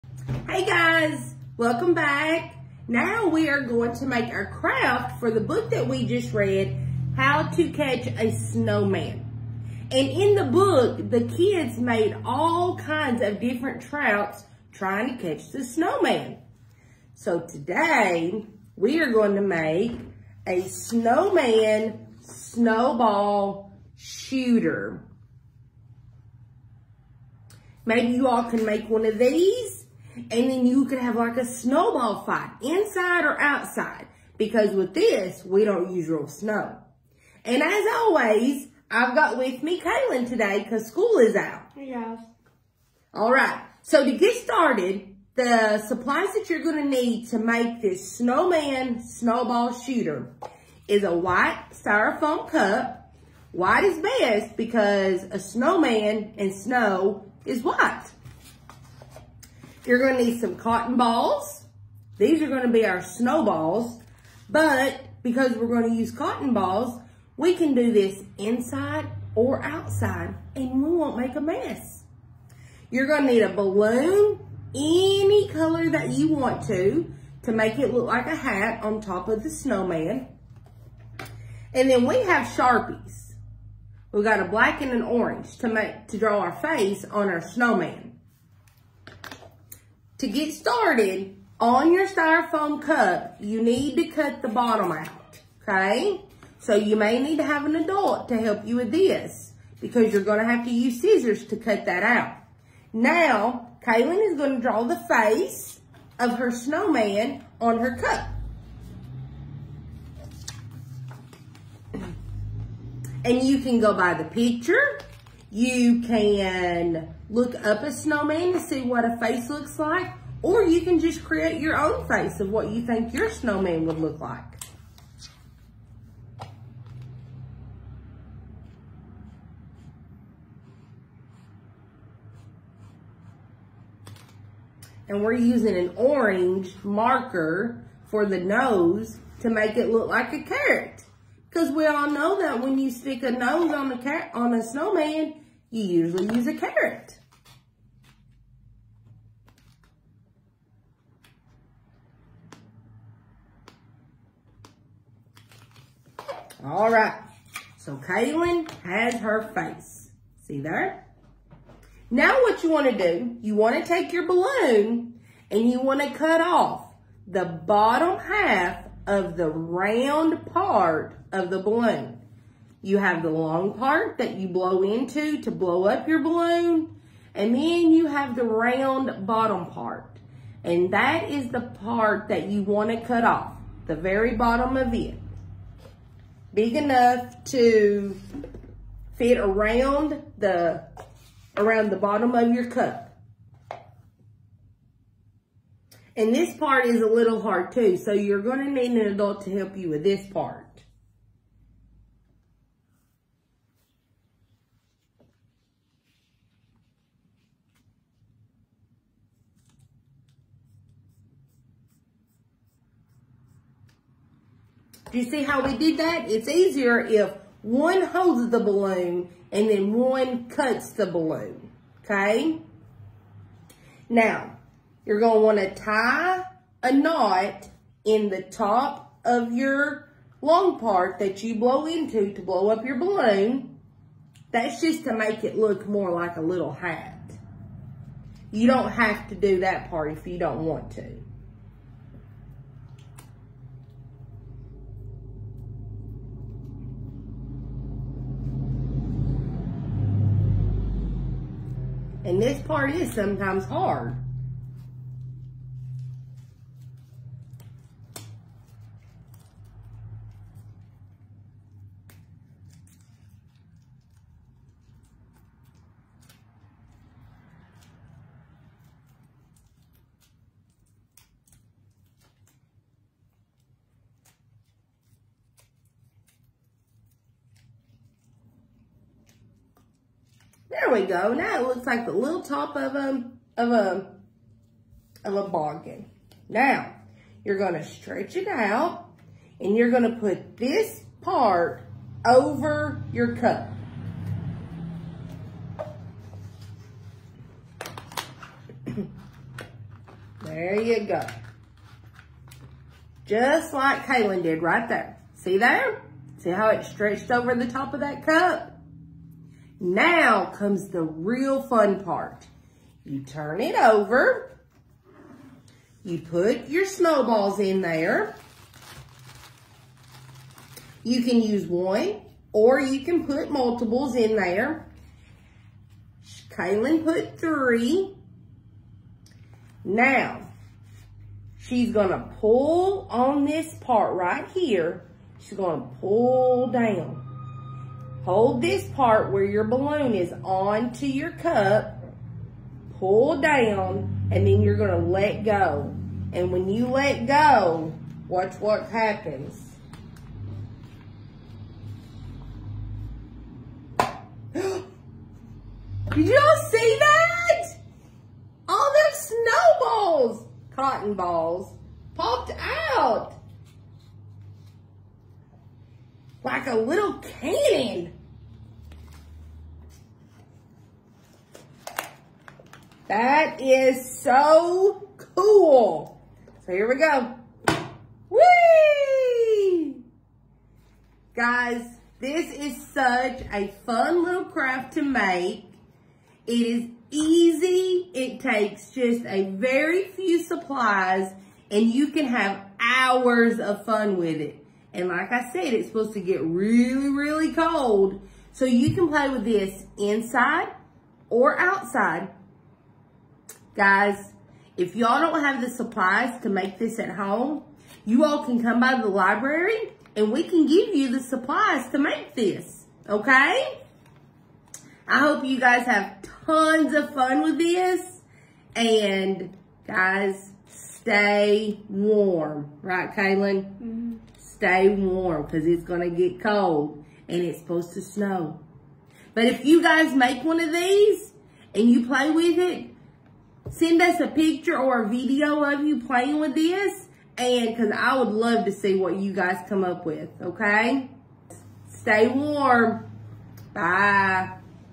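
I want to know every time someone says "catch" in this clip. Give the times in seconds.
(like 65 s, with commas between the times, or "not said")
7 s, 15 s.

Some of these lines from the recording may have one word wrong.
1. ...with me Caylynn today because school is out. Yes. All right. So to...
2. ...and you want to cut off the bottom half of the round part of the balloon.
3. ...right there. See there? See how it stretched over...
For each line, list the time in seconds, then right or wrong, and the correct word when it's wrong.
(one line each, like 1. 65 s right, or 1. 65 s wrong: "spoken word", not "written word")
1. 39 s right
2. 165 s right
3. 304 s right.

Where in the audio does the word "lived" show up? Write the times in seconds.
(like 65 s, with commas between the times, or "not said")
not said.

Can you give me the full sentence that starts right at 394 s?
And like I said, it's supposed to get really, really cold.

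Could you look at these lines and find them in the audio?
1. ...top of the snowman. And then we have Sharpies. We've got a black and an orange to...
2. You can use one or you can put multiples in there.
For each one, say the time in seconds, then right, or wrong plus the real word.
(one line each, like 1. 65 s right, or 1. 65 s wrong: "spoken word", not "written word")
1. 79 s right
2. 321 s right.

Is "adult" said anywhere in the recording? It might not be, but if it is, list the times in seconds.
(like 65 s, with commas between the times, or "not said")
97 s, 199 s.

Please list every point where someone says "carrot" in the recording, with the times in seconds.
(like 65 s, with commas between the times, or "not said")
140 s, 146 s.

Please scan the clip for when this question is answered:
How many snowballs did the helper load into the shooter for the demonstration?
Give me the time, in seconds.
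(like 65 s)
327 s.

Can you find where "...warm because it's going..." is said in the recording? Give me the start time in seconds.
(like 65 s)
424 s.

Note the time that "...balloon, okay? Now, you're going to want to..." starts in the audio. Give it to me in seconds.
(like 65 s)
221 s.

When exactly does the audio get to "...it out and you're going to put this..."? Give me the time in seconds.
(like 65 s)
288 s.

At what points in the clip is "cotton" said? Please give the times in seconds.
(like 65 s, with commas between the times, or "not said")
60 s, 66 s, 360 s.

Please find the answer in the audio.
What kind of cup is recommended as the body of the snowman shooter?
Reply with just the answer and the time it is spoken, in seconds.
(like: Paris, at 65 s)
White styrofoam cup, at 51 s.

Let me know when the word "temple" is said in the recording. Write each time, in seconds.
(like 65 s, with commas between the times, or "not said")
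not said.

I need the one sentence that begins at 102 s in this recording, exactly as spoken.
Now, Caylynn is gonna draw the face of her snowman on her cup.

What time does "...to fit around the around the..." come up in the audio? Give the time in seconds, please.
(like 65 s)
187 s.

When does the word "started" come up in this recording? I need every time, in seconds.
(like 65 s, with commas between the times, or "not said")
44 s, 90 s.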